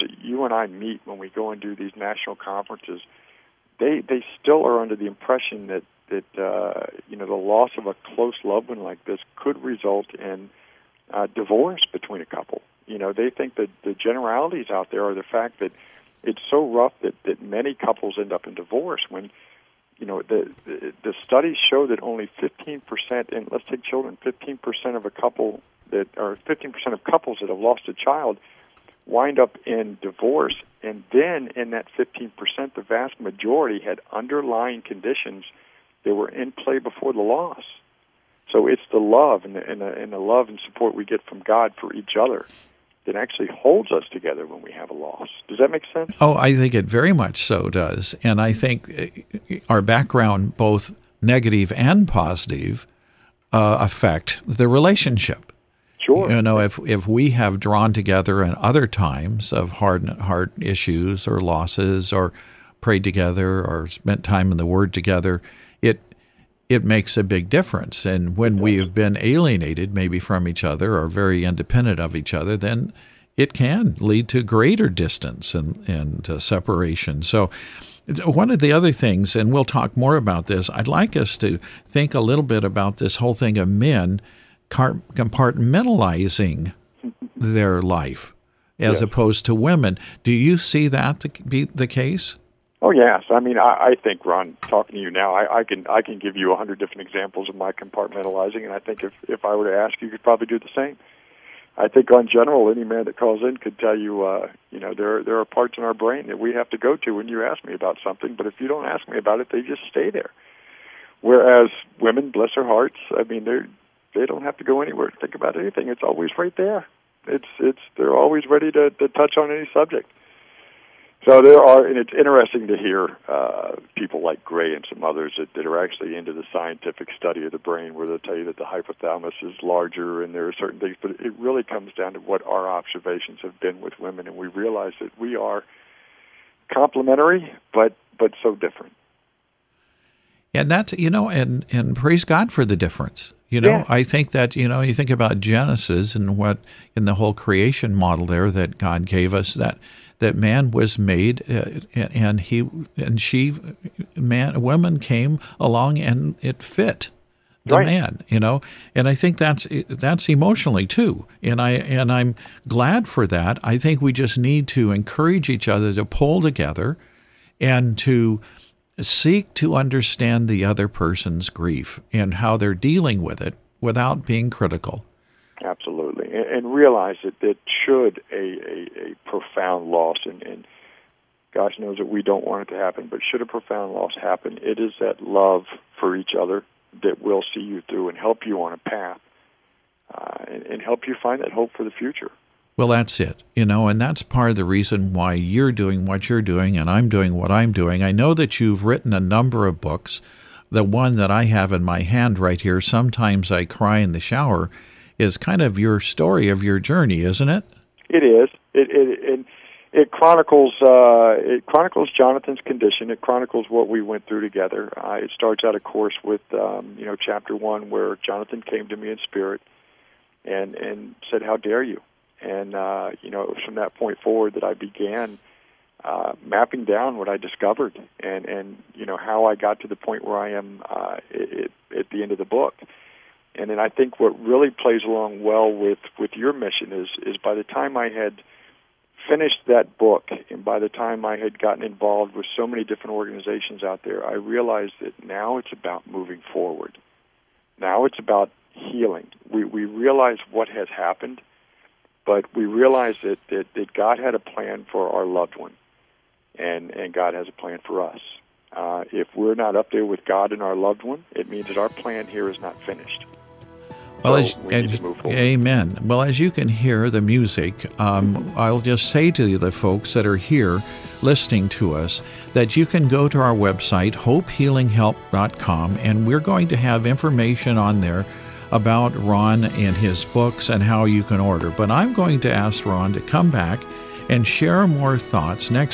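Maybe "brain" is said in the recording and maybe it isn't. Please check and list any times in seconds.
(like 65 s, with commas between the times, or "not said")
105 s, 127 s.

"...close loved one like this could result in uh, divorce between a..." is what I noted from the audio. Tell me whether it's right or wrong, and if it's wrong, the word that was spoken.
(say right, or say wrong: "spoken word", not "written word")
right.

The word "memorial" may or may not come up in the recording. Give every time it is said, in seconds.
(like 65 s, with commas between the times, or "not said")
not said.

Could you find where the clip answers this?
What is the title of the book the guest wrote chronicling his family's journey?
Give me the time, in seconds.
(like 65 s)
202 s.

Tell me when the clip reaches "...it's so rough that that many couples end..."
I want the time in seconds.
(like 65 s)
16 s.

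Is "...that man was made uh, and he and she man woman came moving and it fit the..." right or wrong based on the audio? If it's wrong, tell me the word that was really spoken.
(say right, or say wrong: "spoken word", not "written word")
wrong: "along", not "moving".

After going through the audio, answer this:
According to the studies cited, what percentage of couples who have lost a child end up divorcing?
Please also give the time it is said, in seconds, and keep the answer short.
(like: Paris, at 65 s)
15%, at 22 s.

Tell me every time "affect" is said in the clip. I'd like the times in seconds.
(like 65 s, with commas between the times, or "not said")
53 s.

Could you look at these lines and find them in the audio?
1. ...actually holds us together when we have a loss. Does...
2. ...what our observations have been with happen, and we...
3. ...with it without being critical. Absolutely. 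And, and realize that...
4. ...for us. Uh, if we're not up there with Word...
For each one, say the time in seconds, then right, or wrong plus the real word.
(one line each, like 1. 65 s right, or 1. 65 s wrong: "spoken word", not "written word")
1. 43 s right
2. 132 s wrong: "women", not "happen"
3. 173 s right
4. 257 s wrong: "God", not "Word".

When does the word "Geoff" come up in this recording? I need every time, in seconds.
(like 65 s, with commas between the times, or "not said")
not said.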